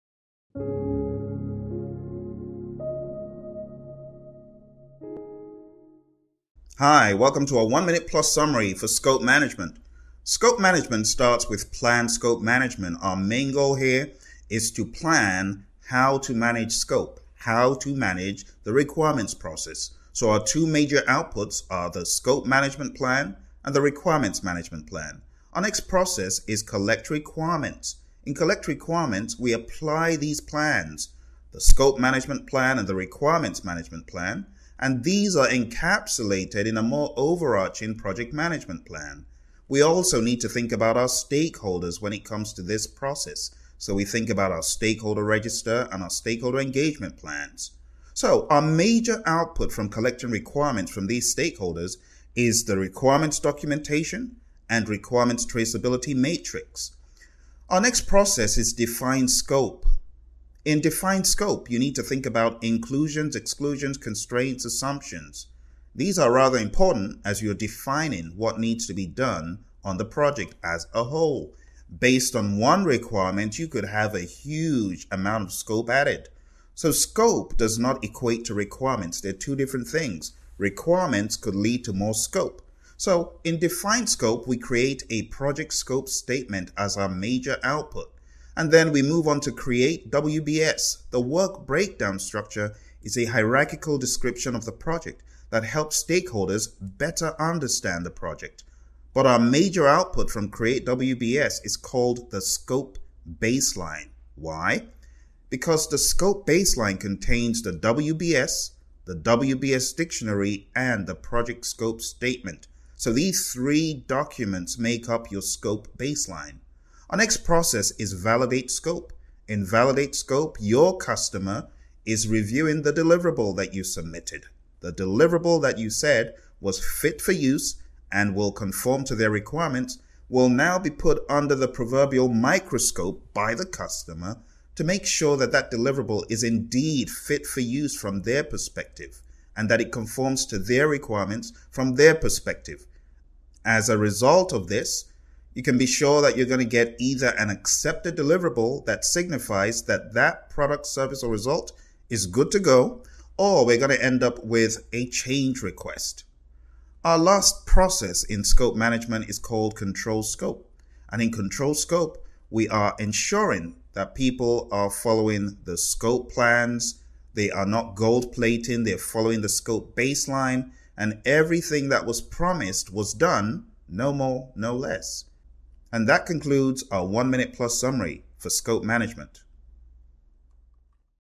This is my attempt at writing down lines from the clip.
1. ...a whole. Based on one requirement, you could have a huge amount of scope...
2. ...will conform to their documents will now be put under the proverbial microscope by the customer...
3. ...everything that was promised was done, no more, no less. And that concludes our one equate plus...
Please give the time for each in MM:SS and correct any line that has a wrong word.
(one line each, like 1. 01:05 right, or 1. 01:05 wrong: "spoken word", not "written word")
1. 01:10 right
2. 02:08 wrong: "requirements", not "documents"
3. 02:51 wrong: "minute", not "equate".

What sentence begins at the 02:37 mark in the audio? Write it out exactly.
Our last process in scope management is called control scope.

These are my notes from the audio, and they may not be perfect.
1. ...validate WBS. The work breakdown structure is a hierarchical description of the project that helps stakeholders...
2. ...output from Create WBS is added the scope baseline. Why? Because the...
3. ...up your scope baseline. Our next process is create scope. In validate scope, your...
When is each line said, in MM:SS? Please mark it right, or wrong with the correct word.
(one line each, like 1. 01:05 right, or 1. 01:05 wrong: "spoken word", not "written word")
1. 01:29 wrong: "create", not "validate"
2. 01:39 wrong: "called", not "added"
3. 01:55 wrong: "validate", not "create".